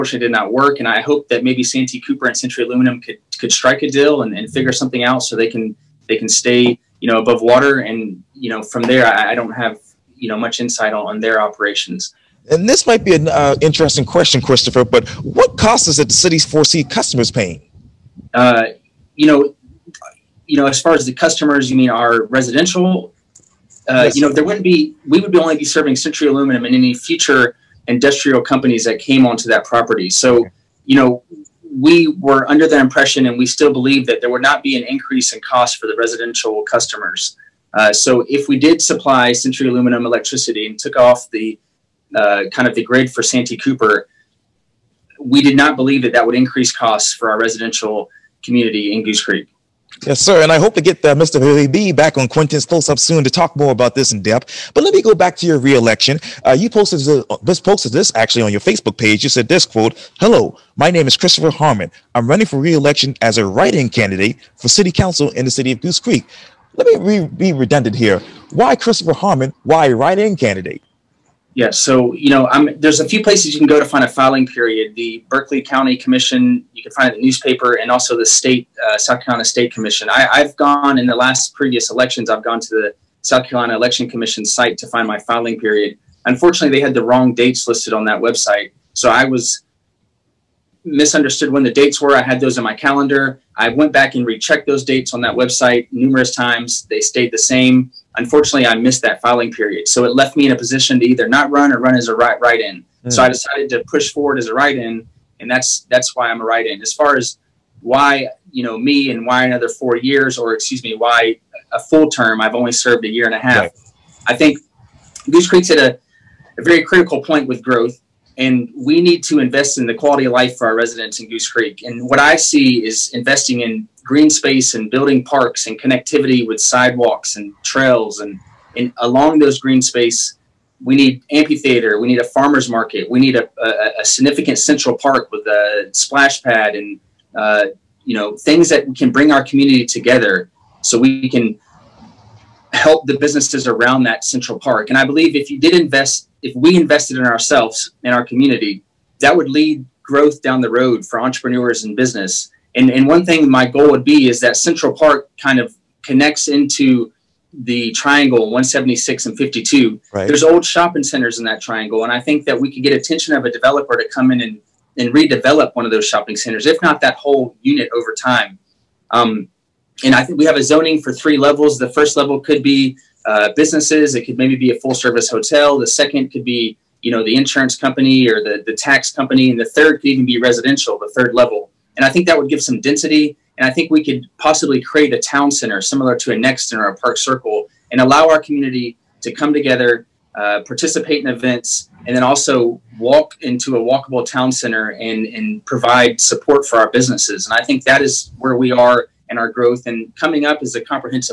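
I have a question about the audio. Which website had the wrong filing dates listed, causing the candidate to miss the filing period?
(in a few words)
South Carolina Election Commission.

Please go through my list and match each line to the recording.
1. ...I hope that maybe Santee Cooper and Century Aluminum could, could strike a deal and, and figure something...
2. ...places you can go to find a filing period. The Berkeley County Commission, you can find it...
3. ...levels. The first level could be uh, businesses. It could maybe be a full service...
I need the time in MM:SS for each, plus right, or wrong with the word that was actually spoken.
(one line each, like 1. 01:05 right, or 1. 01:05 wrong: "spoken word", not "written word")
1. 00:00 right
2. 01:13 right
3. 02:51 right.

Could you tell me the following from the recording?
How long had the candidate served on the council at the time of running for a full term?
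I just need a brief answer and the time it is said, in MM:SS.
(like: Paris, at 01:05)
a year and a half, at 01:53.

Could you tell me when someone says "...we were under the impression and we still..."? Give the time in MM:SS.
00:31.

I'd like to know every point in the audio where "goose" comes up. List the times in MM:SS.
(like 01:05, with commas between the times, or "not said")
00:49, 01:05, 01:55, 02:01.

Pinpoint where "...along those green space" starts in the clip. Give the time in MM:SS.
02:08.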